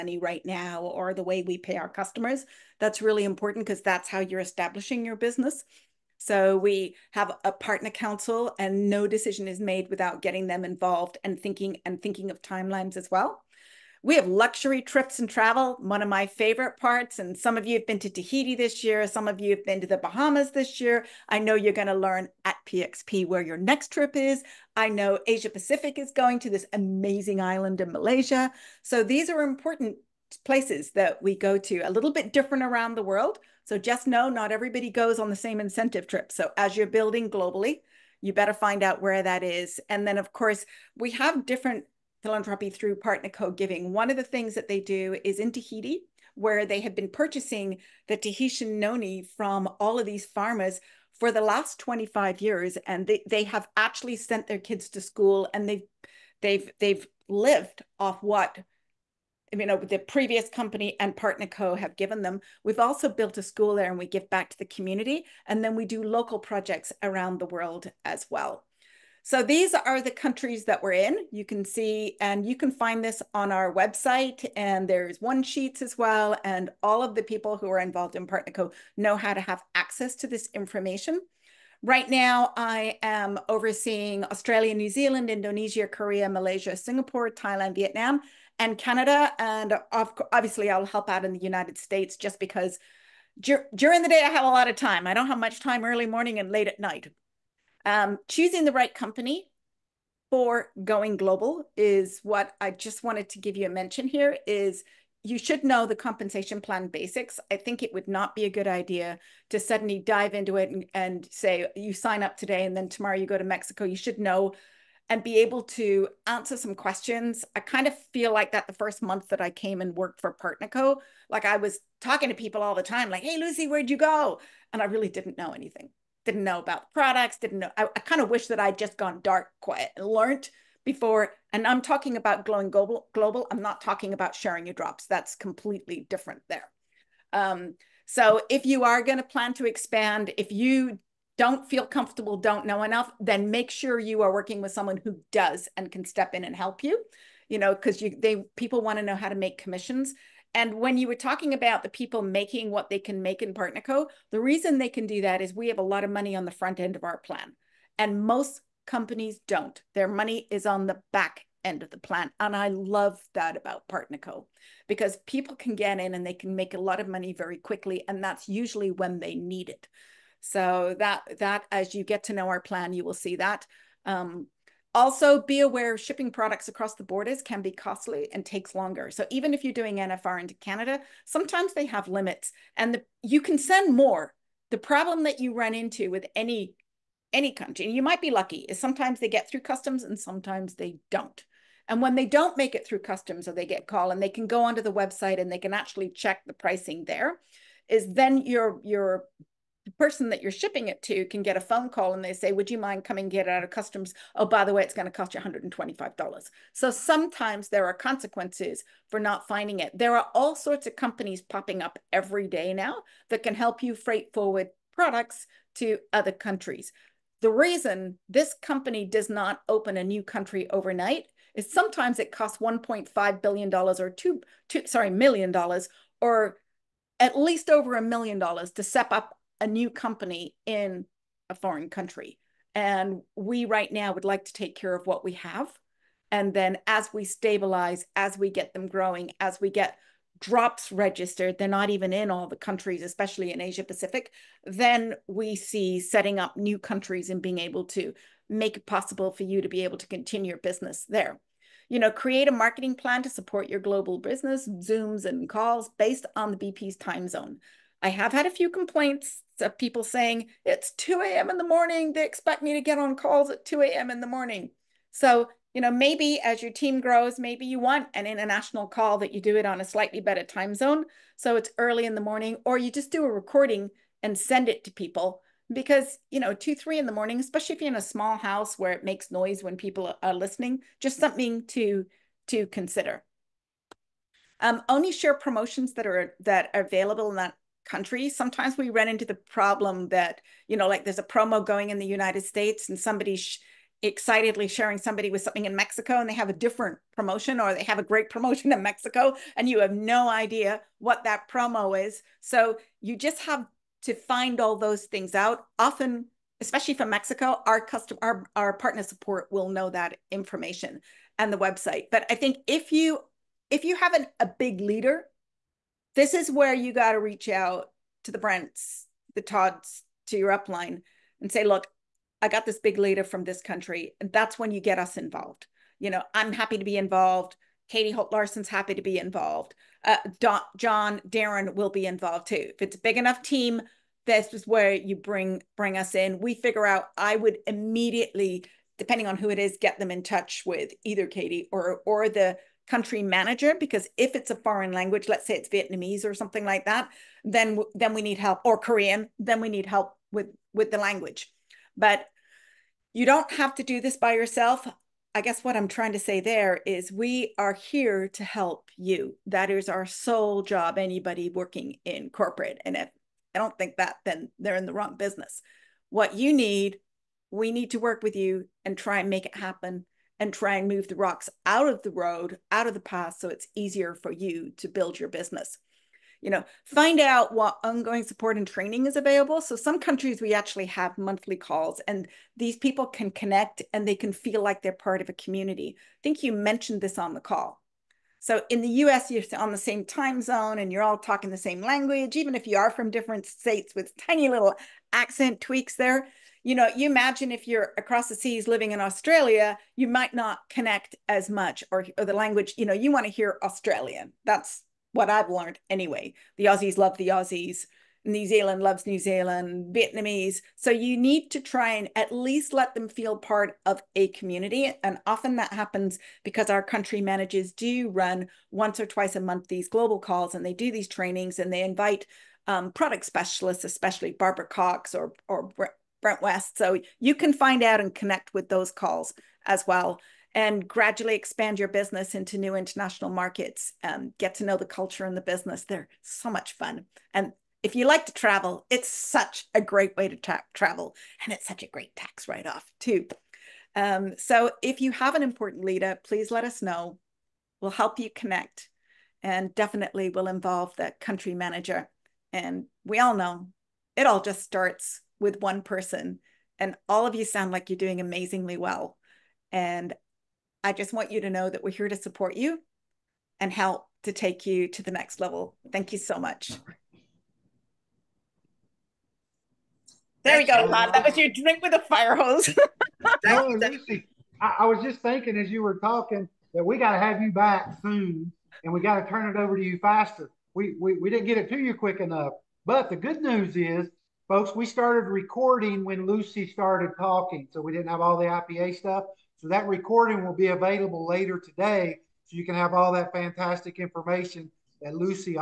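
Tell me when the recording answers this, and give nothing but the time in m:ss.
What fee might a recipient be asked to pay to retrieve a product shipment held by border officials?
3:25.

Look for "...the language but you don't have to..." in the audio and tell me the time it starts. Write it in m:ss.
5:50.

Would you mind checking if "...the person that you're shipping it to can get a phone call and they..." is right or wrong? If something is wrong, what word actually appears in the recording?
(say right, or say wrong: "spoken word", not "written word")
right.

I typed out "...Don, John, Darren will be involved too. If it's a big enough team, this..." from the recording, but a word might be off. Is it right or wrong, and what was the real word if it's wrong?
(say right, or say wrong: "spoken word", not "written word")
right.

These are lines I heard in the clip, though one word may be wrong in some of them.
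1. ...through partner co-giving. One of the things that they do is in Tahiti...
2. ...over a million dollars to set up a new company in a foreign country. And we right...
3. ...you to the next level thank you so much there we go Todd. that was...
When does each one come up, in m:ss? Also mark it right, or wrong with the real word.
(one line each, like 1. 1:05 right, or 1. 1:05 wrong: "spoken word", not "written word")
1. 0:42 right
2. 3:47 right
3. 7:44 right.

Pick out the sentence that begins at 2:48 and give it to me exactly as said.
And that's usually when they need it.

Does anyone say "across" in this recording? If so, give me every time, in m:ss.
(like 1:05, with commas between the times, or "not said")
2:56, 6:37.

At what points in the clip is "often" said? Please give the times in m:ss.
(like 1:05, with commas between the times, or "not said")
5:05, 6:55.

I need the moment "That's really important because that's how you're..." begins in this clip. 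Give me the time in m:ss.
0:02.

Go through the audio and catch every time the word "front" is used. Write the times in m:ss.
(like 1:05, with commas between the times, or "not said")
2:36.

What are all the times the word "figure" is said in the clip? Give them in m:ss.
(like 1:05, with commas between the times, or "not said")
5:36.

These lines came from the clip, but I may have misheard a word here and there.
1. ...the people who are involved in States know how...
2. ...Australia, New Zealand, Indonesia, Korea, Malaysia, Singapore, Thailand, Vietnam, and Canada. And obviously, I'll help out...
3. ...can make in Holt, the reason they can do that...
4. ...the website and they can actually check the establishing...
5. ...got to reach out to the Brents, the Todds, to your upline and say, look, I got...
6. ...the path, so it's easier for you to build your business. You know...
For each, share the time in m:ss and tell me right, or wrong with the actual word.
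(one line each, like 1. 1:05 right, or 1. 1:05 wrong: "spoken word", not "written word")
1. 1:17 wrong: "PartnerCo", not "States"
2. 1:24 right
3. 2:32 wrong: "Partnerco", not "Holt"
4. 3:14 wrong: "pricing", not "establishing"
5. 5:16 right
6. 6:12 right.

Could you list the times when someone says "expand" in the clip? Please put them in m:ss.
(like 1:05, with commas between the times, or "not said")
2:19, 7:11.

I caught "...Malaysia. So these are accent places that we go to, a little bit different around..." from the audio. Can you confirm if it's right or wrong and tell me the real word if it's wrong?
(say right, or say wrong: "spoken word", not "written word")
wrong: "important", not "accent".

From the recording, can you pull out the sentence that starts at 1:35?
I don't have much time early morning and late at night.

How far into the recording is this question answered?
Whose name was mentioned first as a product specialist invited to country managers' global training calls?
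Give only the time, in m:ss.
7:04.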